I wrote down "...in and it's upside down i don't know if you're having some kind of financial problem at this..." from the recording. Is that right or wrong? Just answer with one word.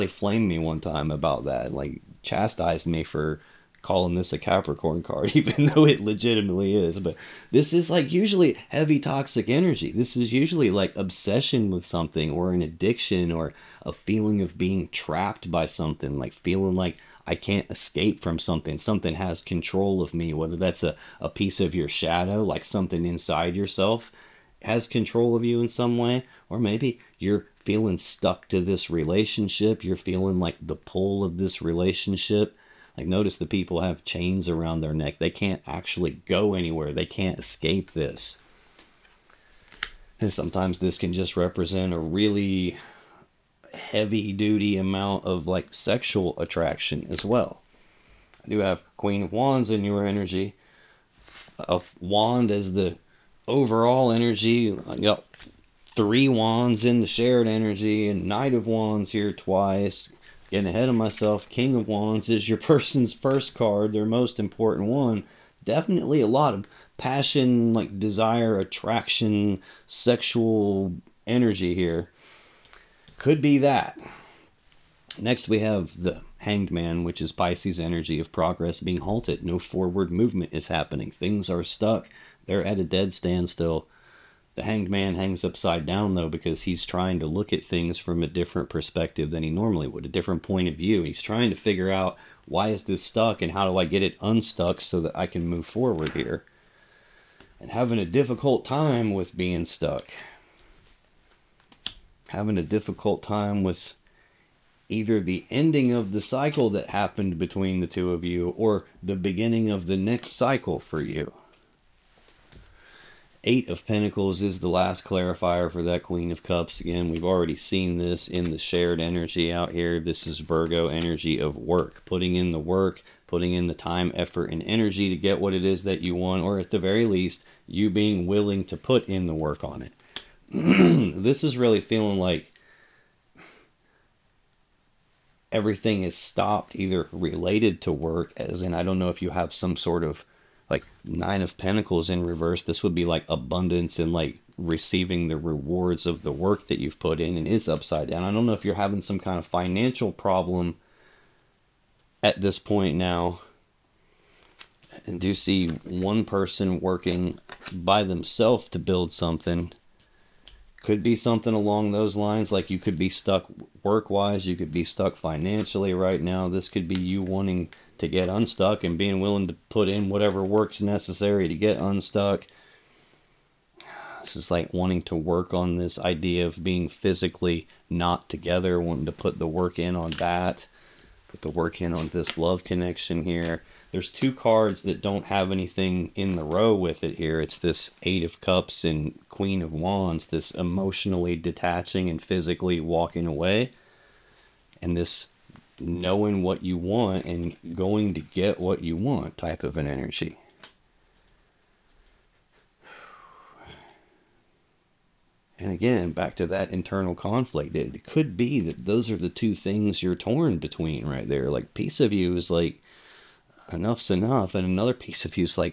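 right.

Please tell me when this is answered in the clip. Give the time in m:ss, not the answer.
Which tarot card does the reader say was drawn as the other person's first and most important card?
1:01.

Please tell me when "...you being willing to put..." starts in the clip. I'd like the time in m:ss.
2:07.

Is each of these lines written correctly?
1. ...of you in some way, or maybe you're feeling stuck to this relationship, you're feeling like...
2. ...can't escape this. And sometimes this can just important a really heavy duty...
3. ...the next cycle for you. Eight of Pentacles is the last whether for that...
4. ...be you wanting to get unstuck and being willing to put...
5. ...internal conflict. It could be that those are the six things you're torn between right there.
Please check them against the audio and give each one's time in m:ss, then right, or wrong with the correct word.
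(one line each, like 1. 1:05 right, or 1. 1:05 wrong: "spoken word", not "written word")
1. 0:25 right
2. 0:37 wrong: "represent", not "important"
3. 1:49 wrong: "clarifier", not "whether"
4. 2:46 right
5. 3:26 wrong: "two", not "six".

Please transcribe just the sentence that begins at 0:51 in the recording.
A wand as the overall energy.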